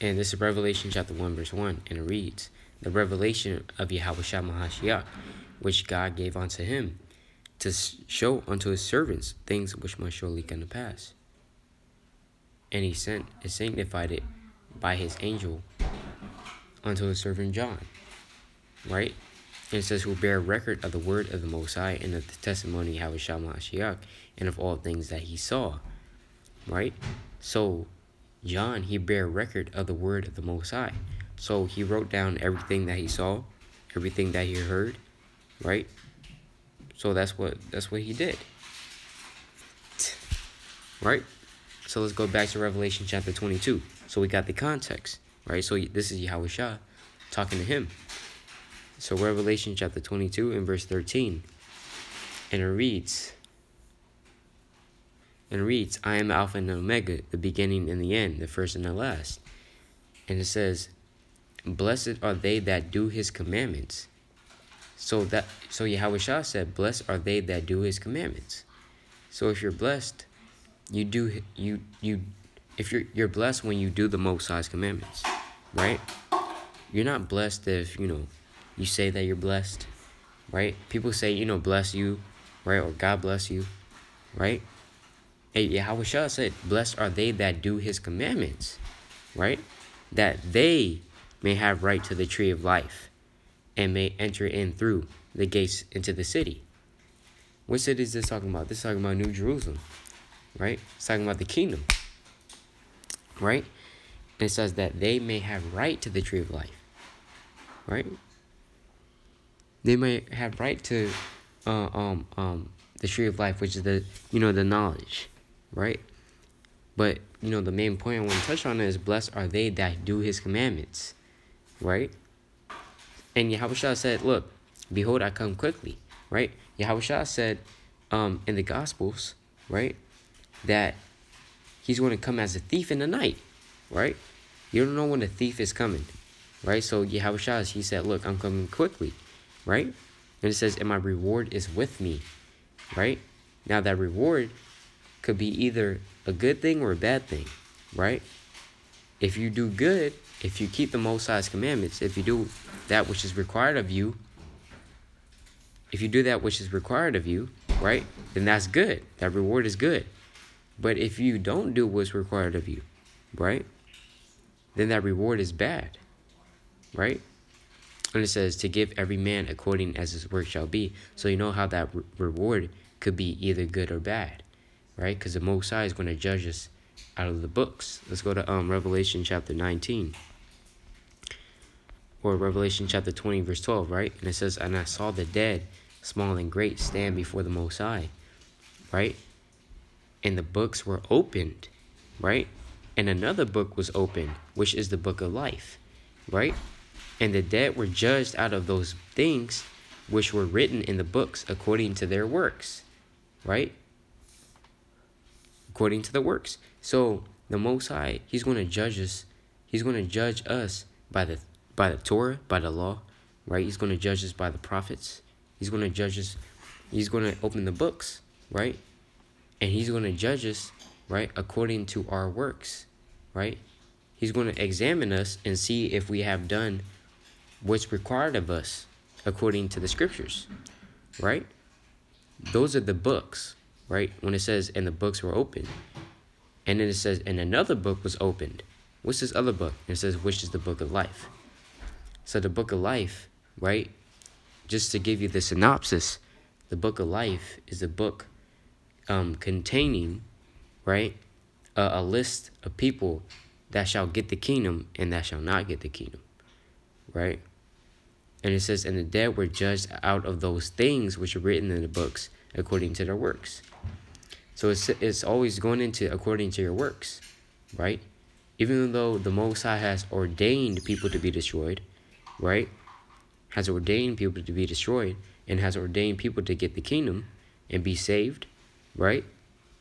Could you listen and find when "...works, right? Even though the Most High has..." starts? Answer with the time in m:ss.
4:26.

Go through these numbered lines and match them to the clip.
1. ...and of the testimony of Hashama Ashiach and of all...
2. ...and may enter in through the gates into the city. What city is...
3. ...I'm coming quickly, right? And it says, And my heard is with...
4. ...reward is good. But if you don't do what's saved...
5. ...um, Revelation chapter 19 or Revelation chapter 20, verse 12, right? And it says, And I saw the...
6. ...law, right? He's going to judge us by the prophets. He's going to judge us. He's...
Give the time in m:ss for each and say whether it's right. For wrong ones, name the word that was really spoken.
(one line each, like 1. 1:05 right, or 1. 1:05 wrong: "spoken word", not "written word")
1. 0:22 right
2. 1:33 right
3. 2:18 wrong: "reward", not "heard"
4. 2:39 wrong: "required", not "saved"
5. 2:58 right
6. 3:32 right.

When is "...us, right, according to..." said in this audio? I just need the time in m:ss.
3:40.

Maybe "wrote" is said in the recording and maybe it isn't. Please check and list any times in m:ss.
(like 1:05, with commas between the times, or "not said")
0:31.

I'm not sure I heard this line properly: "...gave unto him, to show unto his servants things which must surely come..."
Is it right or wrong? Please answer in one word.
right.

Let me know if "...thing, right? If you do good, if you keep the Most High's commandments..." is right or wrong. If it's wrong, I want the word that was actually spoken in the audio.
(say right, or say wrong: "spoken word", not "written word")
right.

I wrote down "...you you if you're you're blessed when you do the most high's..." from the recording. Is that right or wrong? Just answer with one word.
right.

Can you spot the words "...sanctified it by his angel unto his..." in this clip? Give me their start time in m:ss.
0:13.